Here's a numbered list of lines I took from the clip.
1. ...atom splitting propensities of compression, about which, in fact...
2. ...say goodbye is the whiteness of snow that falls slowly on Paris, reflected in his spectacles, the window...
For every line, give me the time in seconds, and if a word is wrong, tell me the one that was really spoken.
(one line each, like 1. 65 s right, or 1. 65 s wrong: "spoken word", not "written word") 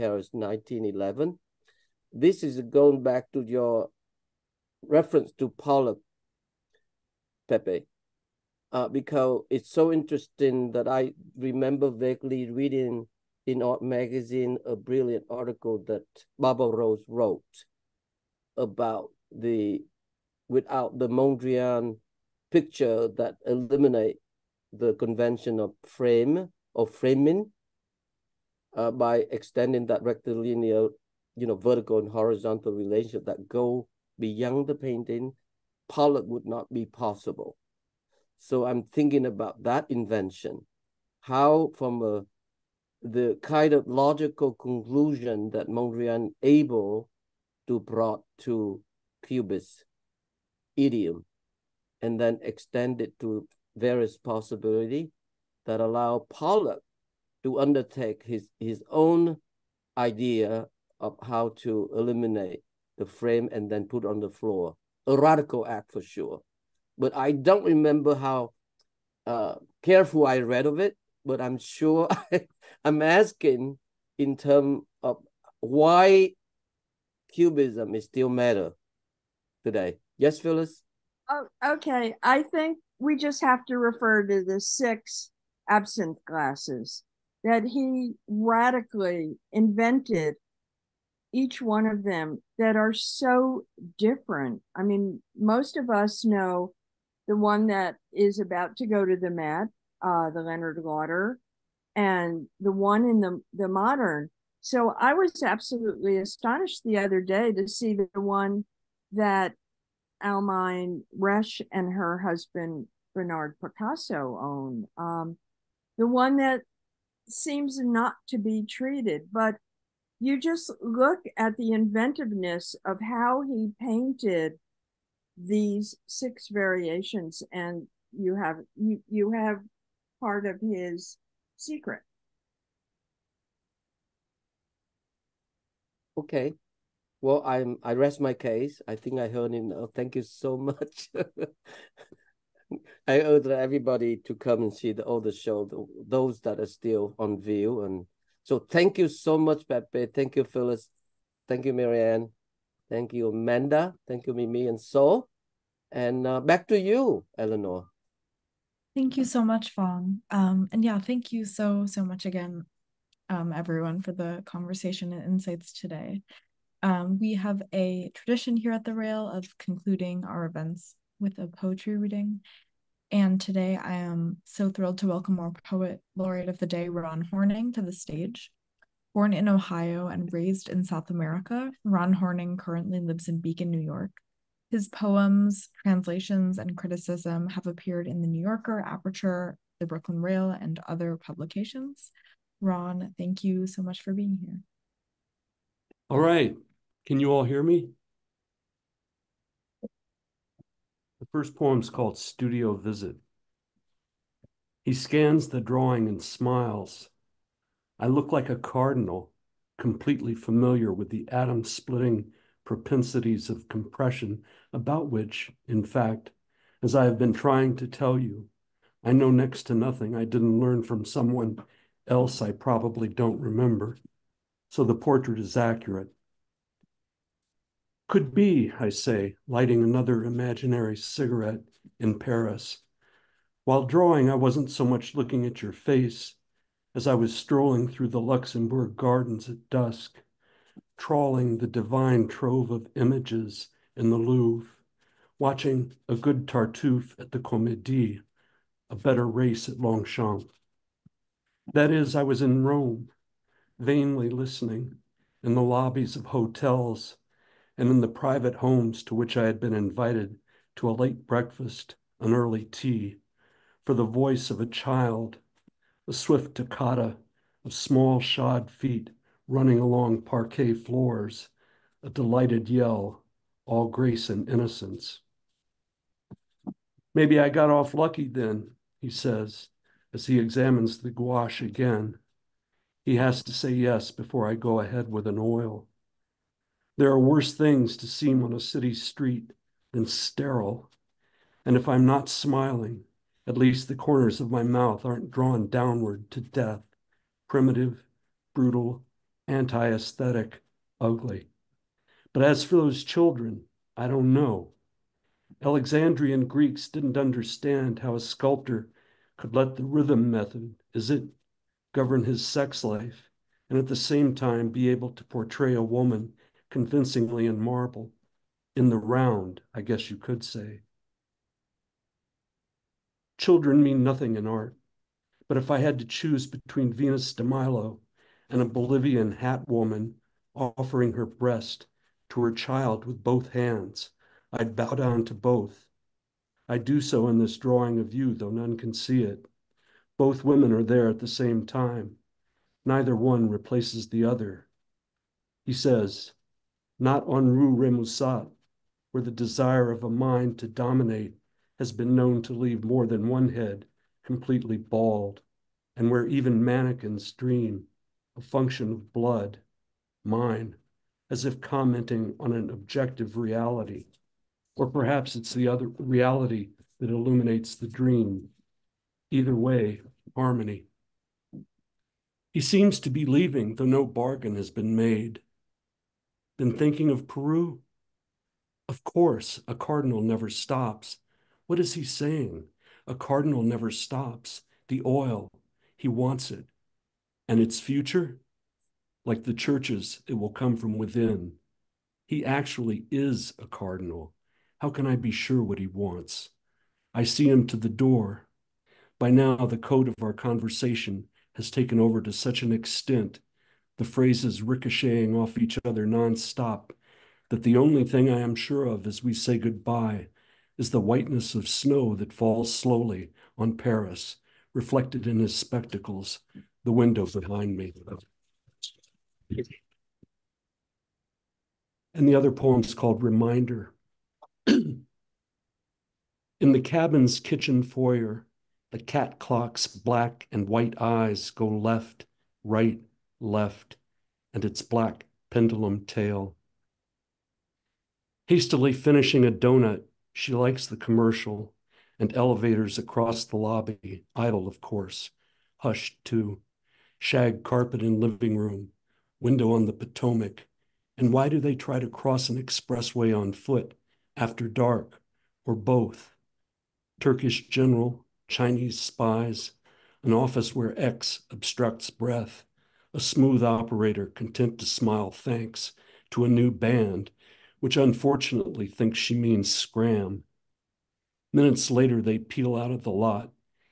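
1. 211 s right
2. 409 s right.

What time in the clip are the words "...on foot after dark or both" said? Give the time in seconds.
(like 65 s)
453 s.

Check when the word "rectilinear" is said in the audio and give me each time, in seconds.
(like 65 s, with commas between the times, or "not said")
30 s.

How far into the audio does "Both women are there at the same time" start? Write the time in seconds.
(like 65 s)
340 s.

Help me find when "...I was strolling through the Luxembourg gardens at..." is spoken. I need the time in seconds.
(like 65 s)
237 s.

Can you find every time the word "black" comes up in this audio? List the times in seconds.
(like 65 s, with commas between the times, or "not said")
429 s, 434 s.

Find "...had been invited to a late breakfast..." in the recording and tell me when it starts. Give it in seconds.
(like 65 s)
259 s.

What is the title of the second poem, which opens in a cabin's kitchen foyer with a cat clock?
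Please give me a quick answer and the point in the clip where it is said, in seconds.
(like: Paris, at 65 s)
Reminder, at 423 s.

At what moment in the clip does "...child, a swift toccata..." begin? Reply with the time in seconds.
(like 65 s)
264 s.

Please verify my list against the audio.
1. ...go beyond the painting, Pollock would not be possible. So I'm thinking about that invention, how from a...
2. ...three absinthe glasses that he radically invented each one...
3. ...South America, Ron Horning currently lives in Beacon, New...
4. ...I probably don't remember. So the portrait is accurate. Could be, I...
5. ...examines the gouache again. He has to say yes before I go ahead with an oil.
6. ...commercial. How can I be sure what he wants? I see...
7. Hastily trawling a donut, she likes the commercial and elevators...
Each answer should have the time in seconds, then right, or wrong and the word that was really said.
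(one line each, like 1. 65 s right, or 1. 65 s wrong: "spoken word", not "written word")
1. 33 s right
2. 84 s wrong: "six", not "three"
3. 180 s right
4. 222 s right
5. 280 s right
6. 393 s wrong: "cardinal", not "commercial"
7. 438 s wrong: "finishing", not "trawling".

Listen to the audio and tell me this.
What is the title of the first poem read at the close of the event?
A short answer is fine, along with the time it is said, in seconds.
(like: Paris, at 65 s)
Studio Visit, at 202 s.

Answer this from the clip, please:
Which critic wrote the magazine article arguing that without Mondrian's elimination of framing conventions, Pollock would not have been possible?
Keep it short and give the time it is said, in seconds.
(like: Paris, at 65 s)
Barbara Rose, at 16 s.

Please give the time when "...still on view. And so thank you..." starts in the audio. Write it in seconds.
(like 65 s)
146 s.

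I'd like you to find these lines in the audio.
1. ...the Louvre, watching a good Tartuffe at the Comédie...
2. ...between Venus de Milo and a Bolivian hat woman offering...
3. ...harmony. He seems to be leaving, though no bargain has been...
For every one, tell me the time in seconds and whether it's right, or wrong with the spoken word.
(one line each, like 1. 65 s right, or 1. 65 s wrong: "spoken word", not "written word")
1. 244 s right
2. 326 s right
3. 370 s right.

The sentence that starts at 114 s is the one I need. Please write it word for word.
Um, the one that seems not to be treated.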